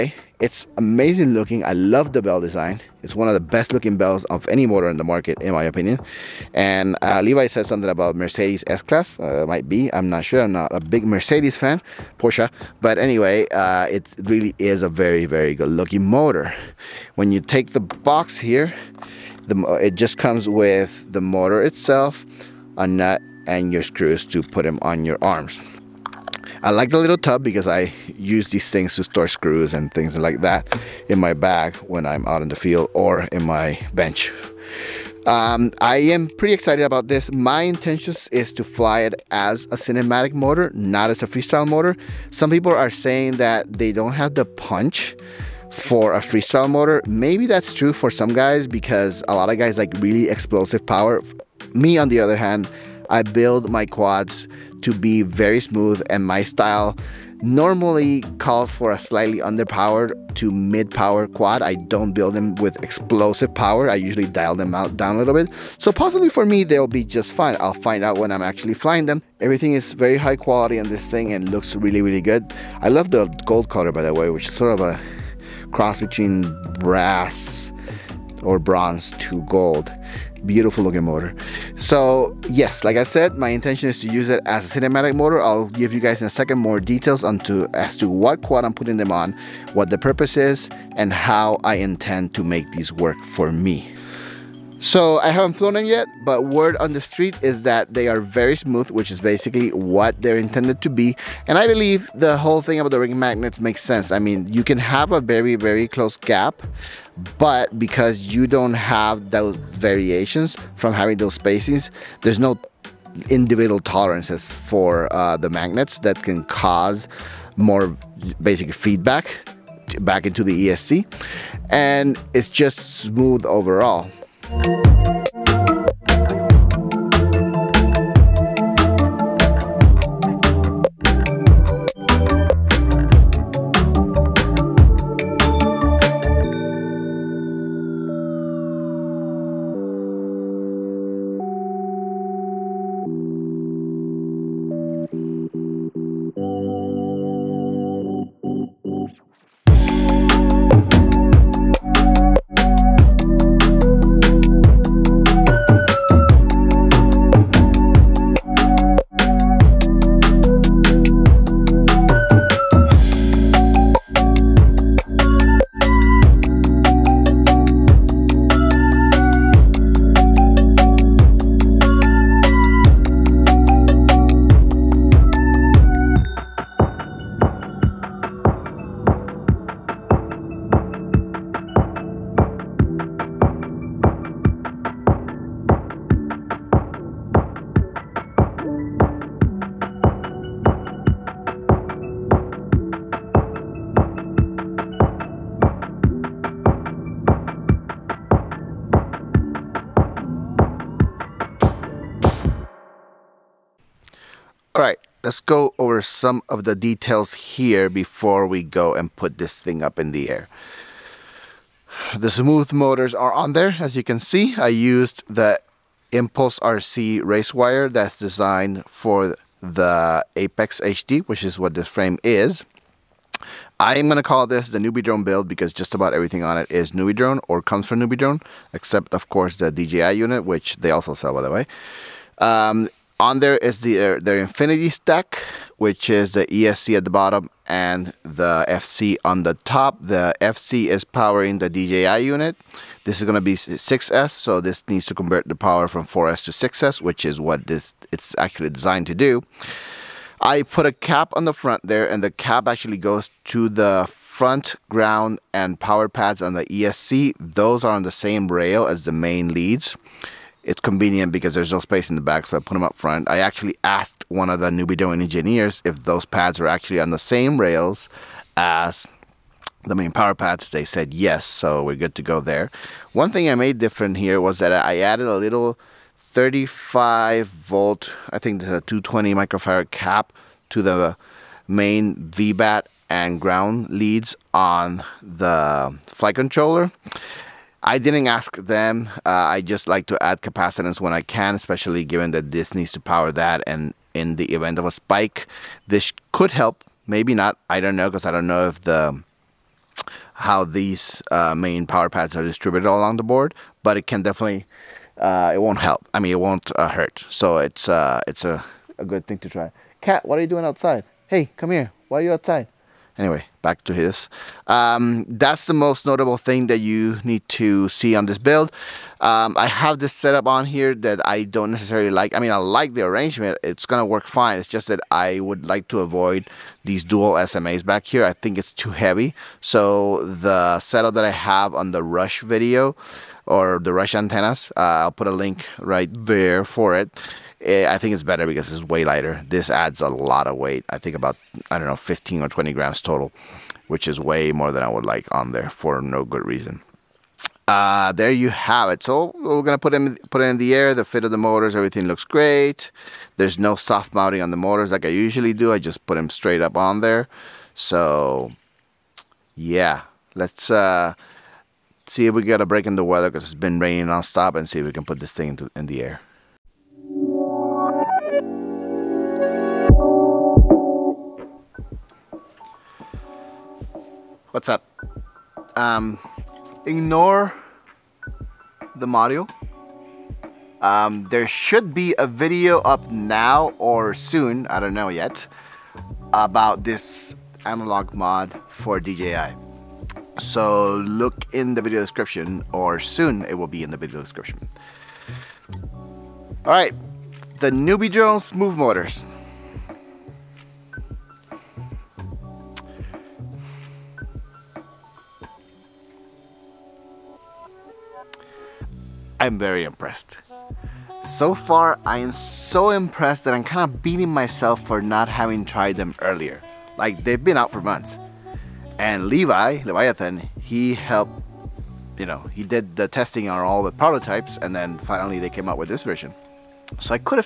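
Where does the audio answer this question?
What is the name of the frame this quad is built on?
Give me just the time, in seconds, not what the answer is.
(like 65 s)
220 s.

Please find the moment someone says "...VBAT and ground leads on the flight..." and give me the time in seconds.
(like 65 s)
282 s.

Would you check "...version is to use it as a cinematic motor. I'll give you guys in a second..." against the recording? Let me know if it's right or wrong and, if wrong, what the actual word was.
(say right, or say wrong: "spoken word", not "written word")
wrong: "intention", not "version".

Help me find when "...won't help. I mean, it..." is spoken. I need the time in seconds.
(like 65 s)
305 s.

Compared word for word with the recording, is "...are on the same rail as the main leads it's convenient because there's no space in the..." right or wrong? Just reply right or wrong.
right.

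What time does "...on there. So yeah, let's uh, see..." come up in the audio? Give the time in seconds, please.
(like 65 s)
356 s.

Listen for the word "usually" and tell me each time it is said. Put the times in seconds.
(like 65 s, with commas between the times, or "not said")
63 s, 355 s.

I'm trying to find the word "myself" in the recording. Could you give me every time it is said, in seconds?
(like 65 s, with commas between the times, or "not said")
414 s.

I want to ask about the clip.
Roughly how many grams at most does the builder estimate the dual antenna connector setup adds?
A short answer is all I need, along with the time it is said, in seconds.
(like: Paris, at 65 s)
20 grams, at 342 s.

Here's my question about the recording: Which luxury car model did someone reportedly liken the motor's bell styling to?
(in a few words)
Mercedes S-Class.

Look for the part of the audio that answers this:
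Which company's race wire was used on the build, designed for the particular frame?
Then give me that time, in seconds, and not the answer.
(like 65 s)
216 s.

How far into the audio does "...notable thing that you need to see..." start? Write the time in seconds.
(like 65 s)
316 s.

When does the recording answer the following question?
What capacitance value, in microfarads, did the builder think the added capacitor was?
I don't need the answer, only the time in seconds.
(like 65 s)
278 s.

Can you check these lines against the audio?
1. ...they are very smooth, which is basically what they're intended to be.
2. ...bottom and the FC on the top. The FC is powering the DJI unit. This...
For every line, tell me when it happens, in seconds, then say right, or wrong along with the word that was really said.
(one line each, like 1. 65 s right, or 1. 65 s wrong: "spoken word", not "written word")
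1. 97 s right
2. 237 s right.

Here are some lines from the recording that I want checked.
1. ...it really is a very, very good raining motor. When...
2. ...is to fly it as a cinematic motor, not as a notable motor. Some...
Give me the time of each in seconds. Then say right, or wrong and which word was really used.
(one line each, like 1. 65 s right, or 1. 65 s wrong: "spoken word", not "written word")
1. 13 s wrong: "looking", not "raining"
2. 38 s wrong: "freestyle", not "notable".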